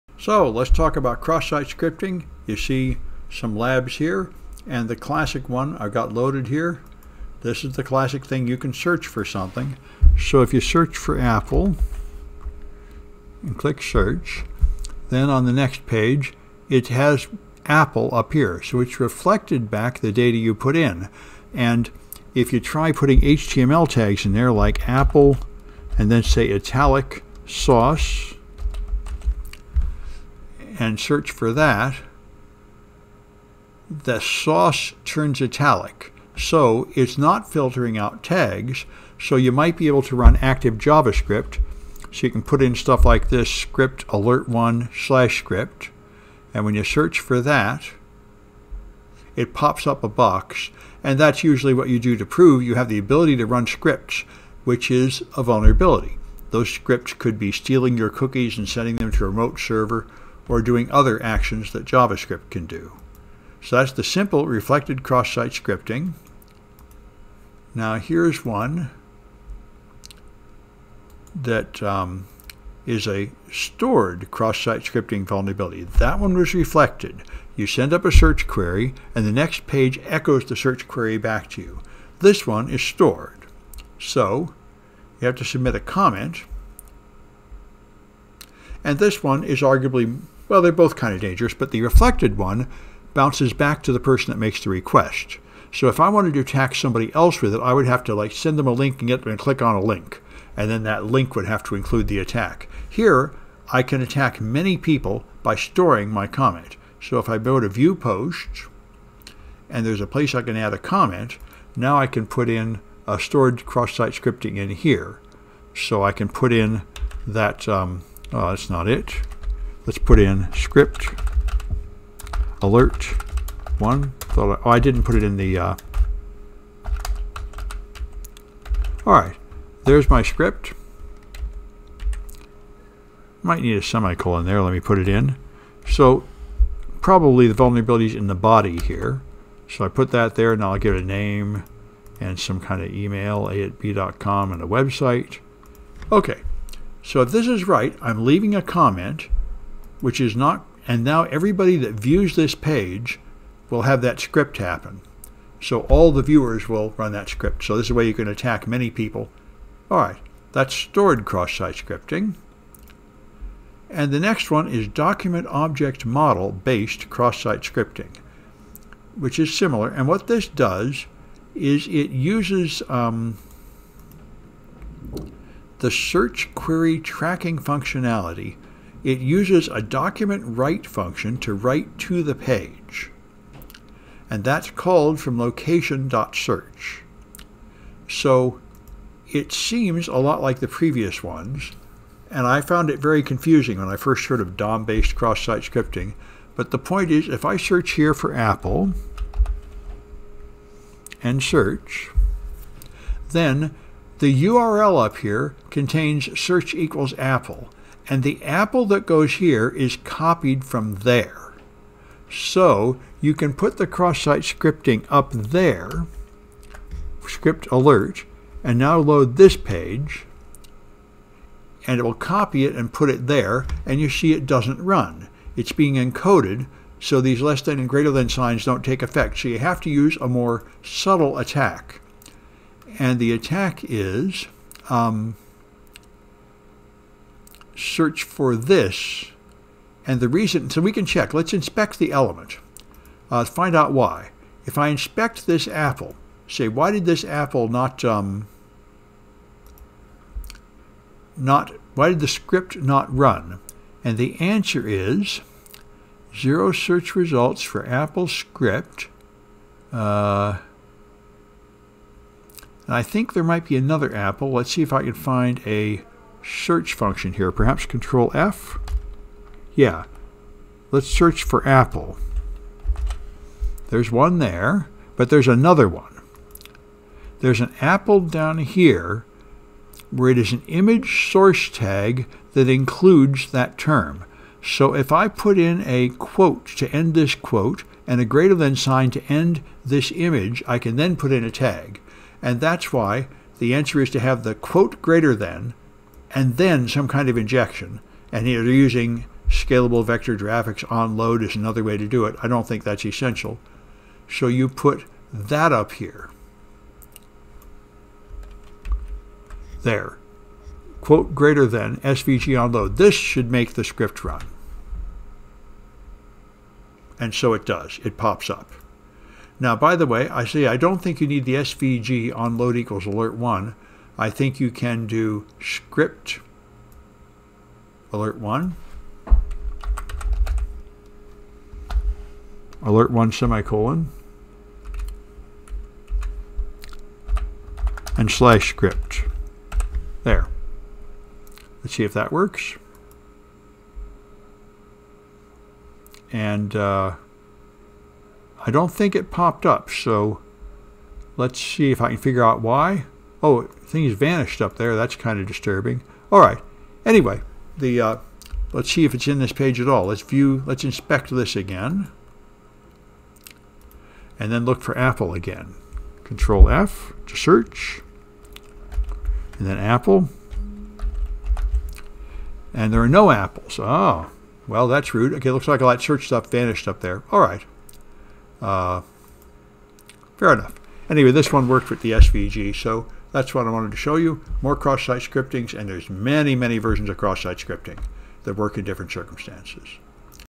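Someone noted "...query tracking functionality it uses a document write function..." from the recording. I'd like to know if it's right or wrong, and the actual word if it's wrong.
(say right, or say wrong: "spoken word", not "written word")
right.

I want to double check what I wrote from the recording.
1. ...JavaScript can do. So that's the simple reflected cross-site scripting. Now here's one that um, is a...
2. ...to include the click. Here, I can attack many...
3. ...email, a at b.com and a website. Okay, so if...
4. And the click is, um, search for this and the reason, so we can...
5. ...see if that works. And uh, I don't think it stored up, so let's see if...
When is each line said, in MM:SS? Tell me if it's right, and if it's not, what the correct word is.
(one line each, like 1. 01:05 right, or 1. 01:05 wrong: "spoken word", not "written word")
1. 01:01 right
2. 01:41 wrong: "attack", not "click"
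3. 02:22 right
4. 03:52 wrong: "attack", not "click"
5. 05:41 wrong: "popped", not "stored".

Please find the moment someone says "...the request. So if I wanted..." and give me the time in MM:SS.
01:34.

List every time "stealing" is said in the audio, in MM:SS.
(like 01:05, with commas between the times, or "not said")
00:57.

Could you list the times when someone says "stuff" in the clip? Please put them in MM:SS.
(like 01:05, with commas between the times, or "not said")
00:42, 06:16.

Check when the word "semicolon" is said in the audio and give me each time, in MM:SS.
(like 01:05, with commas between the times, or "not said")
02:13, 05:33.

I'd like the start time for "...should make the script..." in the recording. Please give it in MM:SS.
05:13.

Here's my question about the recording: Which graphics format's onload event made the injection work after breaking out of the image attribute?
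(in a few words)
scalable vector graphics.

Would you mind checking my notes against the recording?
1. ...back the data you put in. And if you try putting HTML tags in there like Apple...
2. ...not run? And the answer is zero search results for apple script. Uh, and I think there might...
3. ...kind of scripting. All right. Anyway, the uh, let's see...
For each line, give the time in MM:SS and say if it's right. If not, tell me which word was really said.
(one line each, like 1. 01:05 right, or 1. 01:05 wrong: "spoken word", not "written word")
1. 00:19 right
2. 04:12 right
3. 05:55 wrong: "disturbing", not "scripting".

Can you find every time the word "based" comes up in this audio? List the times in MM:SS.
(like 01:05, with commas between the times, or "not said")
02:46, 03:14.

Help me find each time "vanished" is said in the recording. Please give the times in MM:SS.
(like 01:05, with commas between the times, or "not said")
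05:54, 06:16.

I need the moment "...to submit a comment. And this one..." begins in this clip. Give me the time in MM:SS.
01:25.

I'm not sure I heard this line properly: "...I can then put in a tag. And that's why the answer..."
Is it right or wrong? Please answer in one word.
right.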